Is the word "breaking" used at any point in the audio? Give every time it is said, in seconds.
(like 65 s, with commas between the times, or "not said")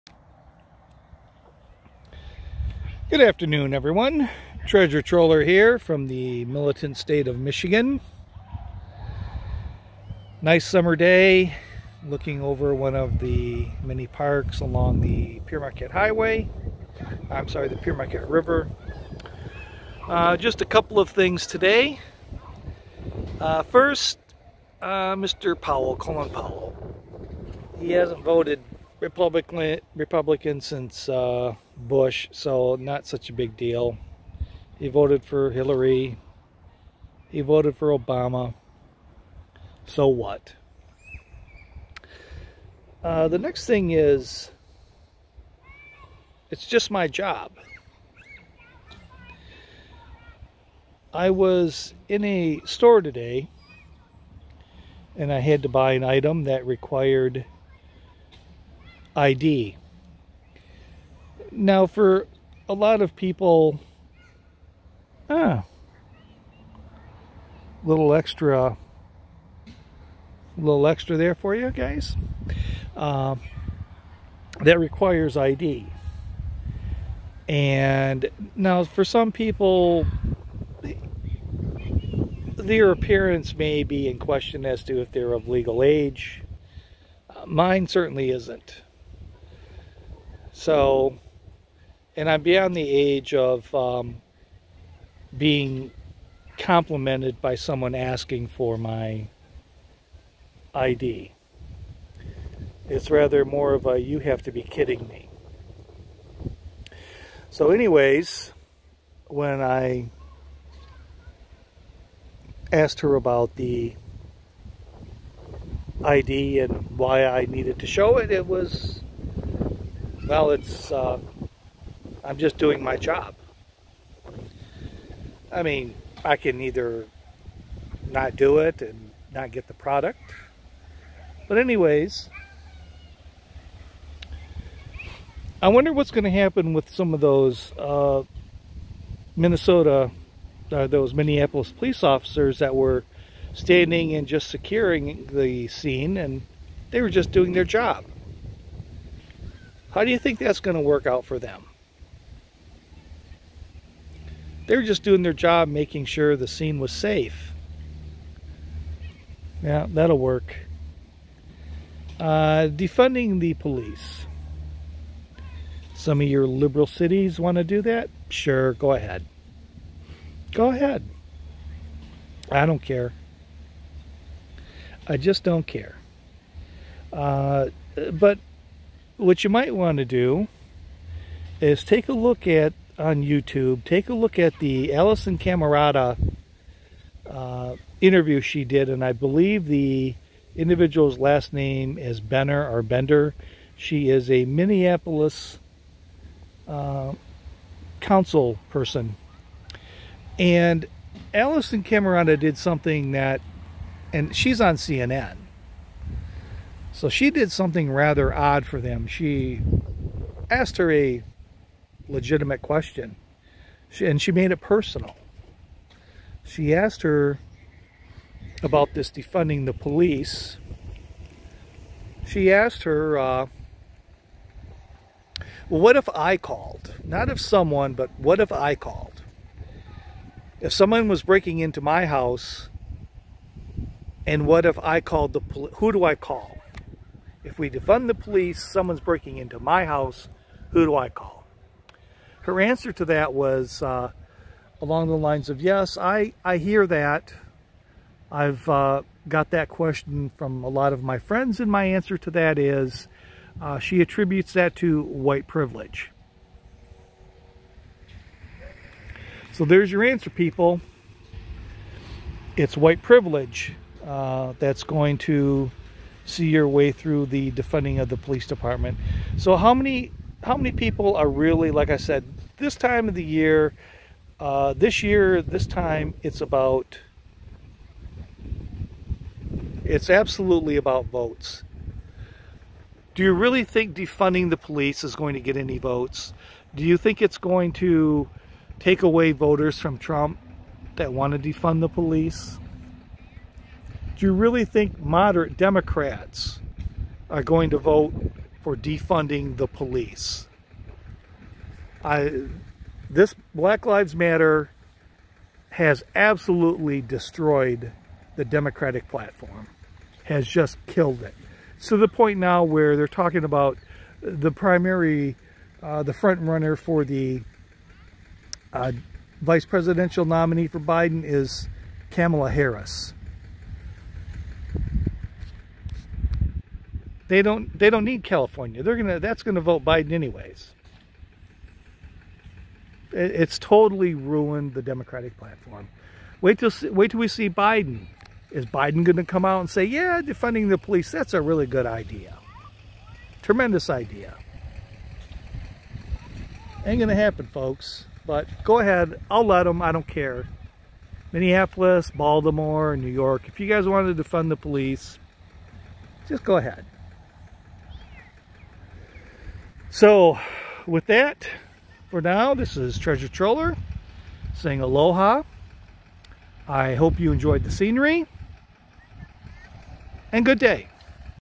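231 s, 238 s.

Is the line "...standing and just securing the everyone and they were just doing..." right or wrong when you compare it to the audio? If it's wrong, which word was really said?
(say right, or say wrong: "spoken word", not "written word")
wrong: "scene", not "everyone".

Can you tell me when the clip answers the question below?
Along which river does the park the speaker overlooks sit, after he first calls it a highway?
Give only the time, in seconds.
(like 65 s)
17 s.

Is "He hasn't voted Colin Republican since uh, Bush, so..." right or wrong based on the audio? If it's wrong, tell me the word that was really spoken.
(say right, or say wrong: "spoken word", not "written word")
wrong: "Republican", not "Colin".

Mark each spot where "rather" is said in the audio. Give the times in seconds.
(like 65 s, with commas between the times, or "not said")
103 s, 207 s.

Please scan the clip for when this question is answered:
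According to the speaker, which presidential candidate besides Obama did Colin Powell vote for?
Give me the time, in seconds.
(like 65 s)
35 s.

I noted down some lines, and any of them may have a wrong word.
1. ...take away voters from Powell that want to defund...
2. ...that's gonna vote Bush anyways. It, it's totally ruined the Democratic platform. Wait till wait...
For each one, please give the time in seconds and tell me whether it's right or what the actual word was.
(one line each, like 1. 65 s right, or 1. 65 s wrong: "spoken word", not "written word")
1. 288 s wrong: "Trump", not "Powell"
2. 329 s wrong: "Biden", not "Bush".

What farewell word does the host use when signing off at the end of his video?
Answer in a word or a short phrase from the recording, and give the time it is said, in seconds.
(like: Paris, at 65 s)
Aloha, at 364 s.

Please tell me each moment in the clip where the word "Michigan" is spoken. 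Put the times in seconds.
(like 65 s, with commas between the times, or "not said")
7 s.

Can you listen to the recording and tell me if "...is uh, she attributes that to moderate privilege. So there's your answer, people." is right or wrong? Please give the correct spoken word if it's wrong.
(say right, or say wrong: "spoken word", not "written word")
wrong: "white", not "moderate".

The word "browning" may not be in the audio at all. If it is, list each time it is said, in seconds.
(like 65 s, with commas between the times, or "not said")
not said.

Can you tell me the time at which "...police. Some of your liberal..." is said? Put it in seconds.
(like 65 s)
163 s.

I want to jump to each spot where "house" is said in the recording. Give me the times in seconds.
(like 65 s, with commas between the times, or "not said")
232 s, 239 s.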